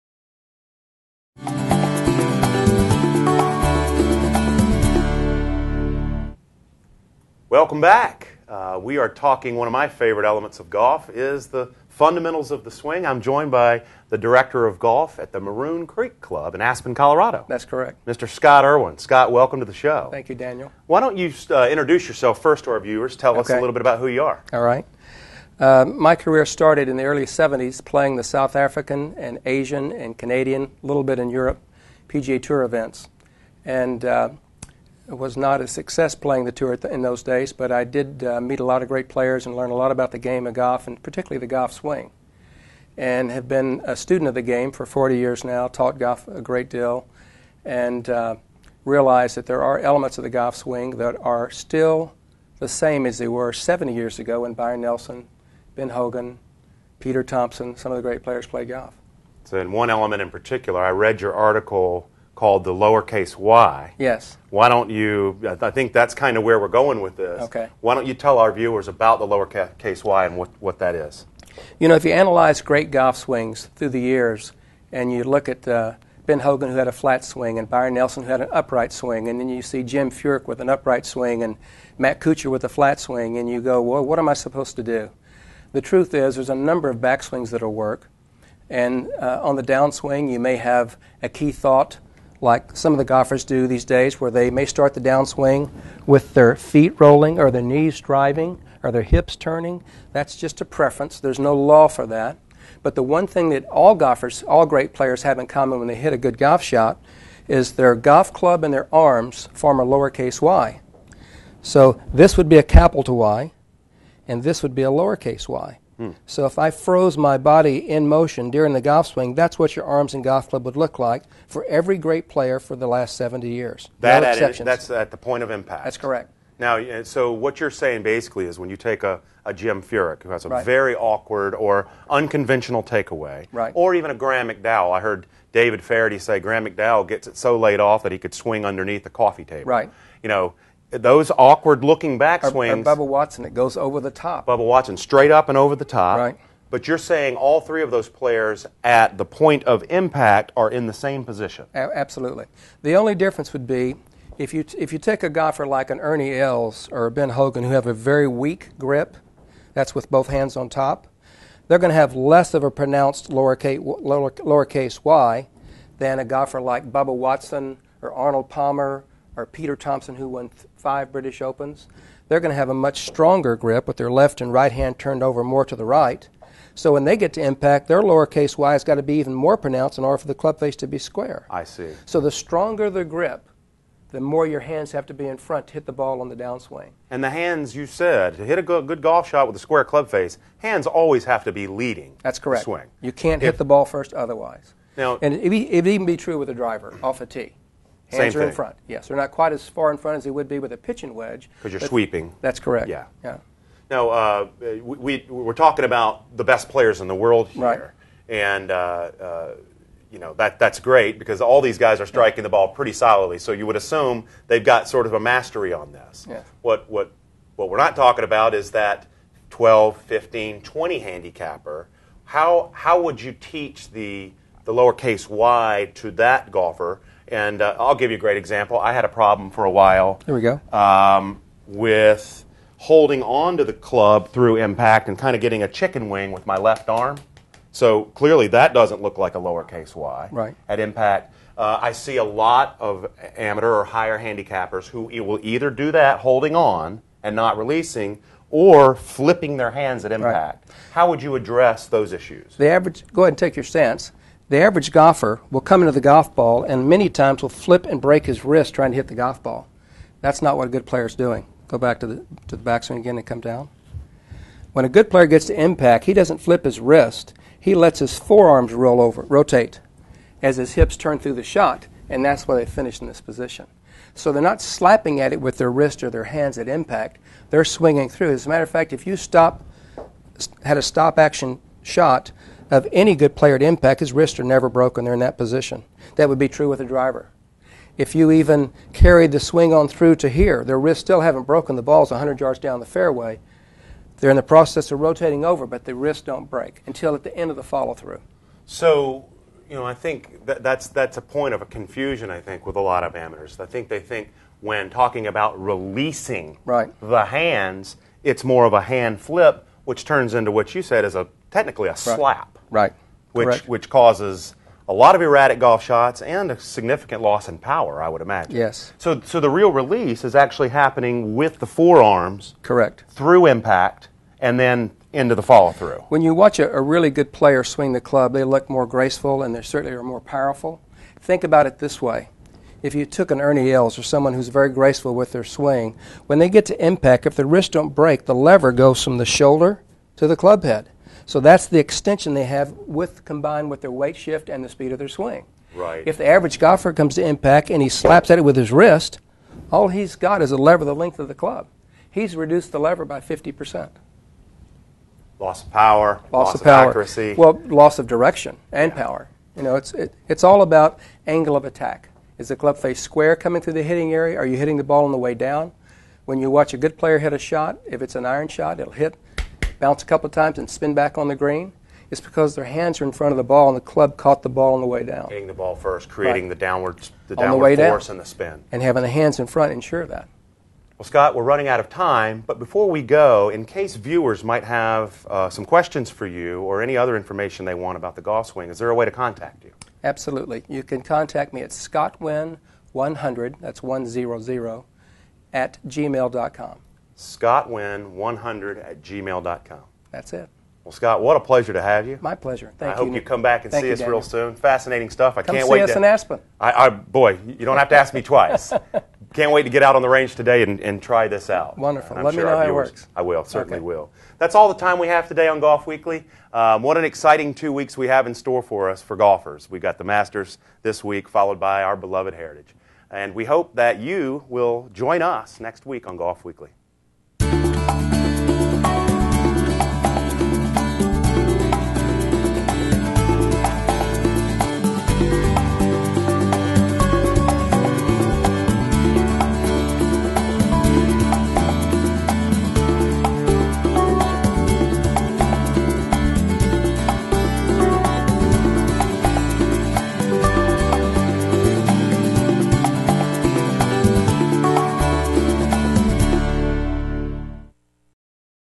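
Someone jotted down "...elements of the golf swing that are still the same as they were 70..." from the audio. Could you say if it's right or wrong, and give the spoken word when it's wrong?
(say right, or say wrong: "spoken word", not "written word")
right.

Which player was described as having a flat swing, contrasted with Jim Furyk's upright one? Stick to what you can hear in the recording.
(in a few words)
Matt Kuchar.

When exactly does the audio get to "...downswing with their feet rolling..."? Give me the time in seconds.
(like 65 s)
94 s.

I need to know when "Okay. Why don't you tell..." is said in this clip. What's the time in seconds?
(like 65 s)
67 s.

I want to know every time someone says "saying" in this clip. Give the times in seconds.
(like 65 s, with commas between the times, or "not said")
127 s, 146 s.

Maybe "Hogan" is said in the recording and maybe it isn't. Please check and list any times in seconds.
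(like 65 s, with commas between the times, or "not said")
55 s, 76 s, 157 s.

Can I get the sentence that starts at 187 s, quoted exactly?
And the hands, you said, to hit a good golf shot with a square club face, hands always have to be leading.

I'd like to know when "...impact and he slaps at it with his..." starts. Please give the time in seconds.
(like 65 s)
347 s.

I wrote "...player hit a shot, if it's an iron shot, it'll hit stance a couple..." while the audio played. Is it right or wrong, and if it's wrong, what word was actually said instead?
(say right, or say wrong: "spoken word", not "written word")
wrong: "bounce", not "stance".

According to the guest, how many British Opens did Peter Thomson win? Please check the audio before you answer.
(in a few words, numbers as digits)
5.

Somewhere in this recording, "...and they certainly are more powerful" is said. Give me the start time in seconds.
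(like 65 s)
329 s.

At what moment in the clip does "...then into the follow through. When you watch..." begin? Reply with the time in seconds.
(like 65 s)
324 s.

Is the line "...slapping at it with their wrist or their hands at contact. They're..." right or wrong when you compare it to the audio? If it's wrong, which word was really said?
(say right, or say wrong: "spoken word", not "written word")
wrong: "impact", not "contact".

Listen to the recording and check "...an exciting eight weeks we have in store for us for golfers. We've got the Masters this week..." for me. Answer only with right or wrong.
wrong.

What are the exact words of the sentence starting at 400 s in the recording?
Well, Scott, what a pleasure to have you.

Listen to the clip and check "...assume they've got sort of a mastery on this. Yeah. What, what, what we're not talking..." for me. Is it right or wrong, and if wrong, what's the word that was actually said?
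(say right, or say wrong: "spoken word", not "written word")
right.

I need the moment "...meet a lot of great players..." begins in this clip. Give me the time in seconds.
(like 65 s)
38 s.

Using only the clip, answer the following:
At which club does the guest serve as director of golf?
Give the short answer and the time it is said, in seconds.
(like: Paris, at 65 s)
Maroon Creek Club, at 15 s.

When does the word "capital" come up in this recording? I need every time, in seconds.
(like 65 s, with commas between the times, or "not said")
112 s.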